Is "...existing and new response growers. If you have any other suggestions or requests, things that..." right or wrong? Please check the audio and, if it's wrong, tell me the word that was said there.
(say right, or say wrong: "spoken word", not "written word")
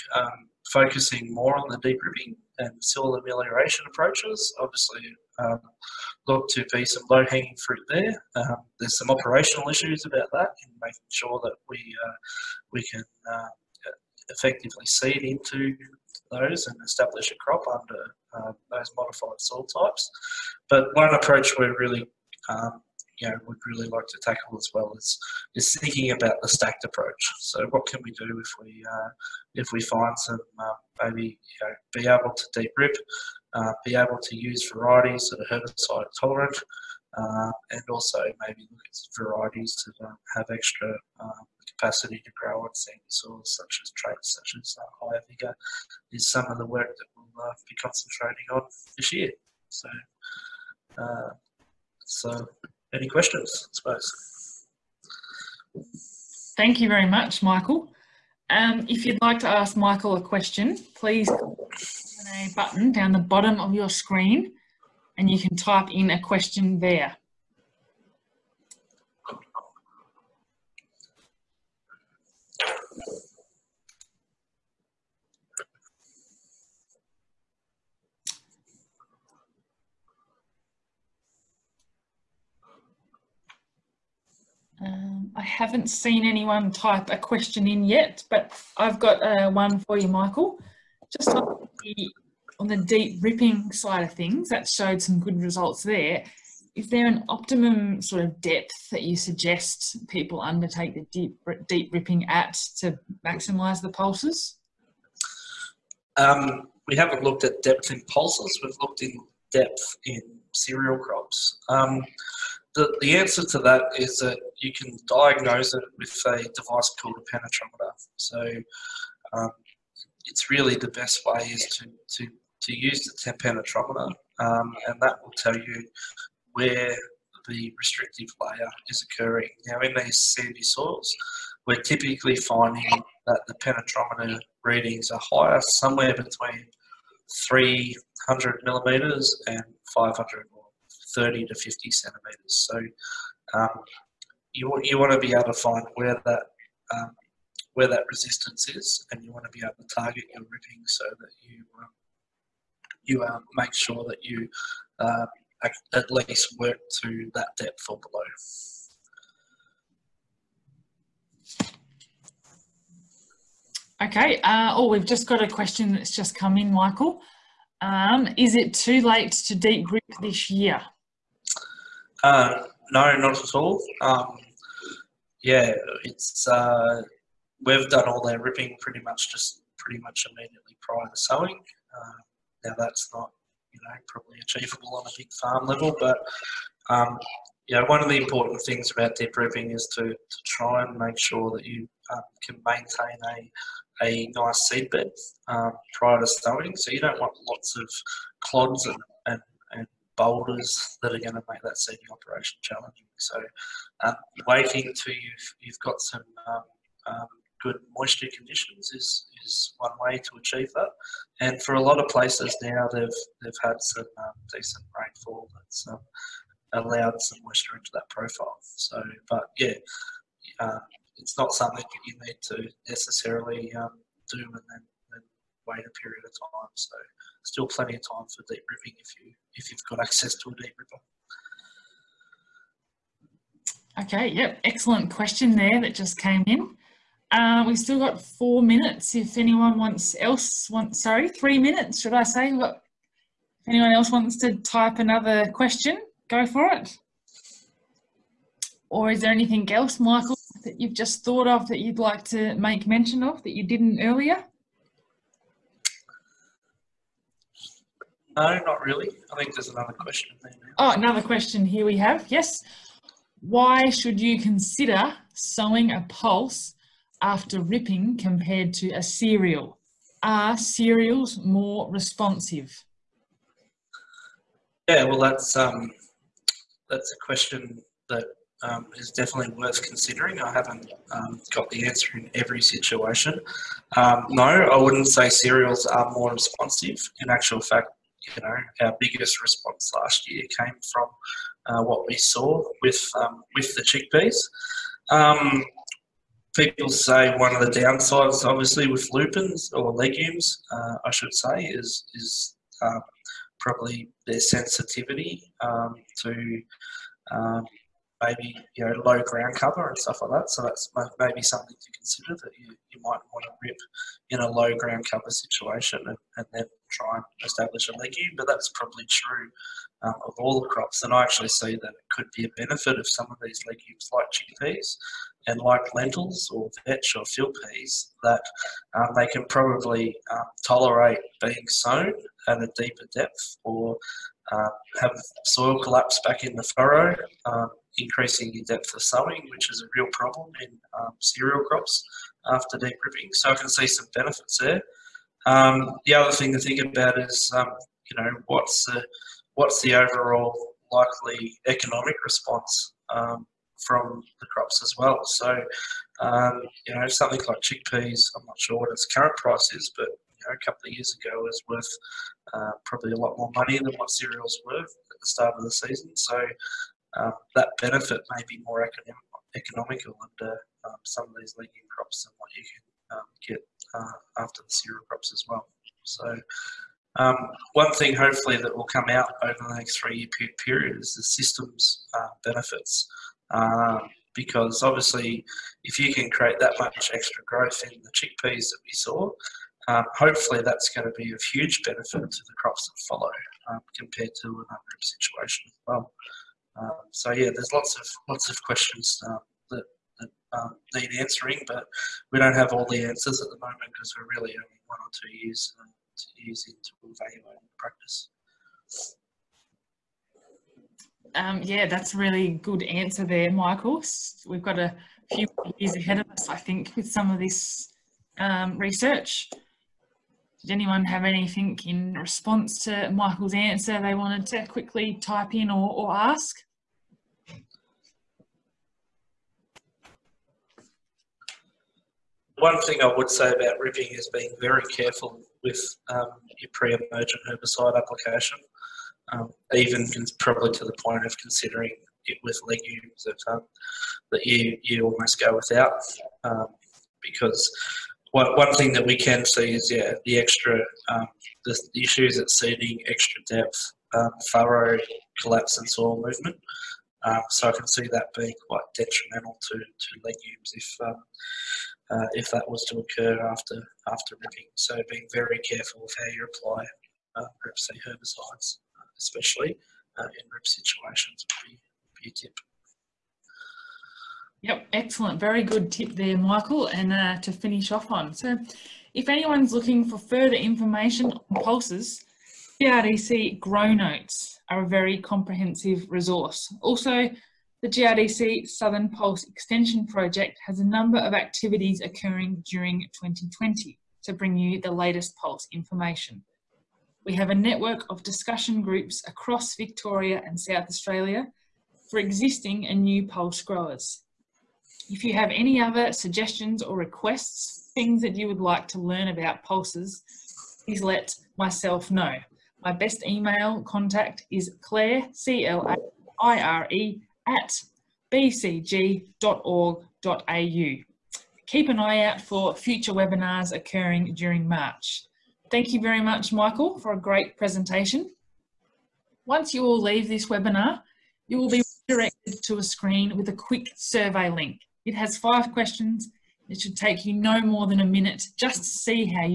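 wrong: "pulse", not "response".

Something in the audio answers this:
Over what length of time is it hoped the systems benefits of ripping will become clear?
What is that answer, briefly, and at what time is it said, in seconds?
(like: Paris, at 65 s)
three-year period, at 379 s.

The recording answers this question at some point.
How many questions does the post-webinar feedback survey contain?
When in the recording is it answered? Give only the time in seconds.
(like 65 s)
535 s.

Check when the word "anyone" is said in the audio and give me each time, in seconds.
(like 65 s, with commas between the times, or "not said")
86 s, 239 s, 243 s, 420 s, 479 s.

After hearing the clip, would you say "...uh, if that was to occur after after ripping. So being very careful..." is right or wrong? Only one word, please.
right.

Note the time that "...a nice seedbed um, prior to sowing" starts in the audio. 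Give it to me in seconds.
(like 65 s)
194 s.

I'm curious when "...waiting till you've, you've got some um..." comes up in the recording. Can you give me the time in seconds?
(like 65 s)
204 s.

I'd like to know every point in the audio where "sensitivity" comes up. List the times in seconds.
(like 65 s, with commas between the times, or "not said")
304 s.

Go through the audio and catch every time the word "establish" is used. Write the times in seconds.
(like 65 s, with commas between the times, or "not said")
16 s, 317 s.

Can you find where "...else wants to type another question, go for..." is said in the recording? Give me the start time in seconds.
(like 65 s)
243 s.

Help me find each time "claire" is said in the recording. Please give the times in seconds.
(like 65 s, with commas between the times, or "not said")
514 s.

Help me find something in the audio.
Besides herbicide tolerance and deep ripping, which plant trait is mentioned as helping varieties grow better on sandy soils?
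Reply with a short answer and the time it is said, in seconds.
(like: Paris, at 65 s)
higher vigor, at 45 s.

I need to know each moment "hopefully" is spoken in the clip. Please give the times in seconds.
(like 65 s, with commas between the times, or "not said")
378 s, 390 s.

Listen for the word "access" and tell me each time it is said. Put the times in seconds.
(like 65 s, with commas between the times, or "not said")
229 s.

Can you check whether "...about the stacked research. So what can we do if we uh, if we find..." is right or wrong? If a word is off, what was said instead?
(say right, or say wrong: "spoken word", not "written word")
wrong: "approach", not "research".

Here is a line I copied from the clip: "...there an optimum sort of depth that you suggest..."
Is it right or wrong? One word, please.
right.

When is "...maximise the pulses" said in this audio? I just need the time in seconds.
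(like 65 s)
103 s.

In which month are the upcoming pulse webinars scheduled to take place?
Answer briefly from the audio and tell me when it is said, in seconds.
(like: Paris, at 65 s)
March, at 524 s.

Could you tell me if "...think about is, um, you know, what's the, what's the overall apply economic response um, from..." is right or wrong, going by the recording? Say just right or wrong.
wrong.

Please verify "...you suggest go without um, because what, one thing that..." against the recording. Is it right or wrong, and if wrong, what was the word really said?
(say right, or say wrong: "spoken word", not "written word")
wrong: "almost", not "suggest".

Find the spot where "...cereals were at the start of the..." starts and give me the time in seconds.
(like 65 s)
364 s.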